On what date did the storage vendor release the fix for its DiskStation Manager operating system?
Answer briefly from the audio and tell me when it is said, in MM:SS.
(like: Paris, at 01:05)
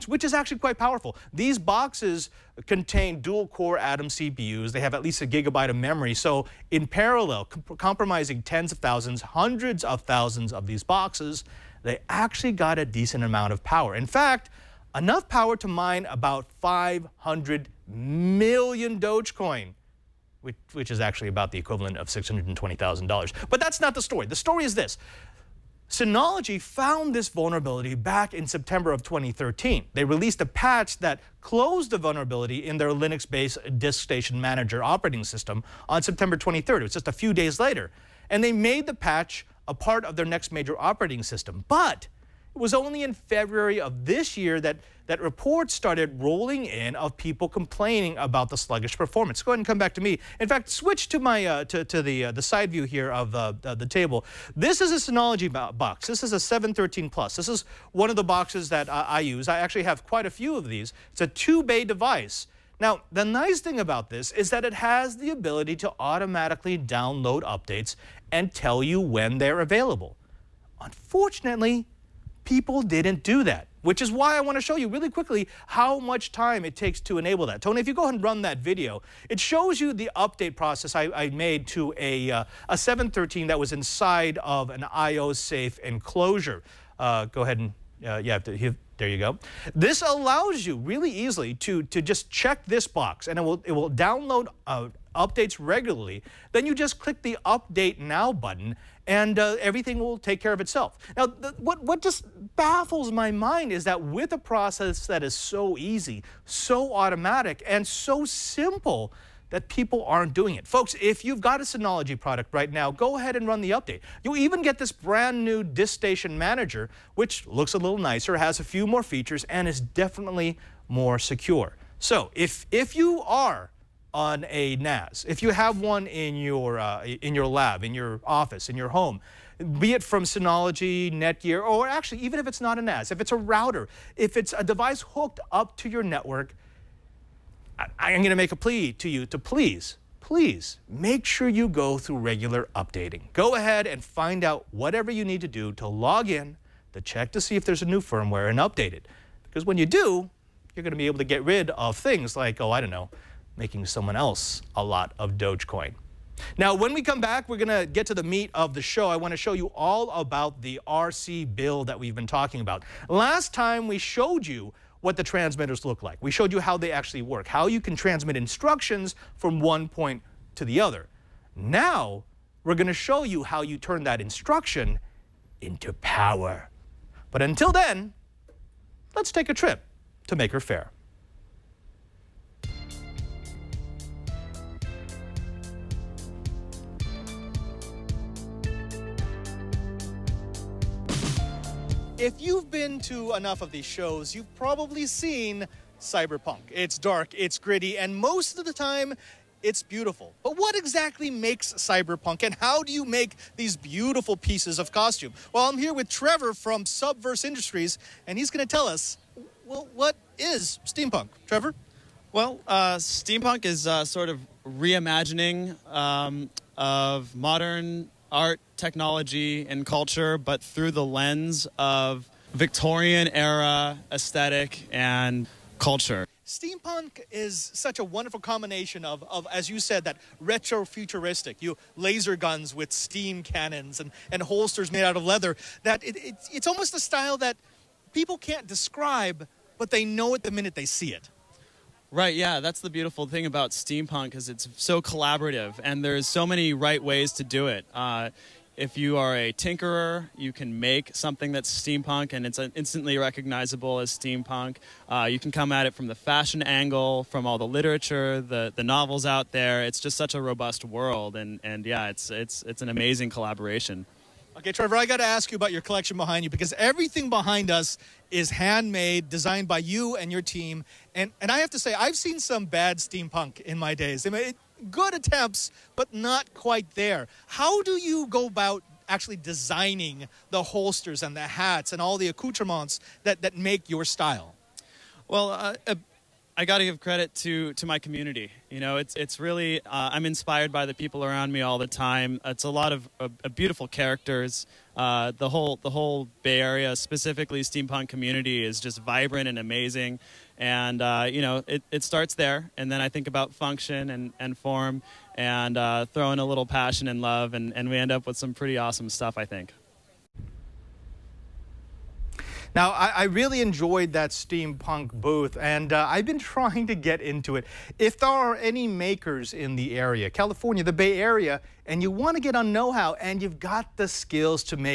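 September 23rd, at 00:36.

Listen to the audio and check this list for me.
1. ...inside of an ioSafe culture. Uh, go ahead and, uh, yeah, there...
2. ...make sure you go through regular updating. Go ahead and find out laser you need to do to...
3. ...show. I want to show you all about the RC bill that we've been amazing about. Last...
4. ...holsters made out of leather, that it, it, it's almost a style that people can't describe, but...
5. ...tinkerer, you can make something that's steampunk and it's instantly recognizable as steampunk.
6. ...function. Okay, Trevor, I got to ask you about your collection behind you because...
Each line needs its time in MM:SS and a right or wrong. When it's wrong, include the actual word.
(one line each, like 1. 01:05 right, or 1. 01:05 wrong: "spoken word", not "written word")
1. 01:23 wrong: "enclosure", not "culture"
2. 02:20 wrong: "whatever", not "laser"
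3. 02:38 wrong: "talking", not "amazing"
4. 03:54 right
5. 04:09 right
6. 04:23 wrong: "collaboration", not "function".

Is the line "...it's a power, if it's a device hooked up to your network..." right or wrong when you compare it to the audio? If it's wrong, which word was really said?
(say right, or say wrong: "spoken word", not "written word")
wrong: "router", not "power".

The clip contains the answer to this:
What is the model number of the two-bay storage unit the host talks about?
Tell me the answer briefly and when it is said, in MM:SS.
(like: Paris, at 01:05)
713 Plus, at 00:56.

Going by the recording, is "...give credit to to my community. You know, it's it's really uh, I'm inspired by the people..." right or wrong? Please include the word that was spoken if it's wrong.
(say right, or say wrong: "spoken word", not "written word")
right.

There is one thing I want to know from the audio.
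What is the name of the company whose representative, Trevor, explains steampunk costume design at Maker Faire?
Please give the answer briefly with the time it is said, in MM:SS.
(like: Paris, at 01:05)
Subverse Industries, at 03:26.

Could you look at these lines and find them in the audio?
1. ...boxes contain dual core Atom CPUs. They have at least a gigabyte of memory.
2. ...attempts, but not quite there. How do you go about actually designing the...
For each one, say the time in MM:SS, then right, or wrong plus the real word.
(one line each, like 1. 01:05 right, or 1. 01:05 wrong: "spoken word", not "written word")
1. 00:01 right
2. 04:35 right.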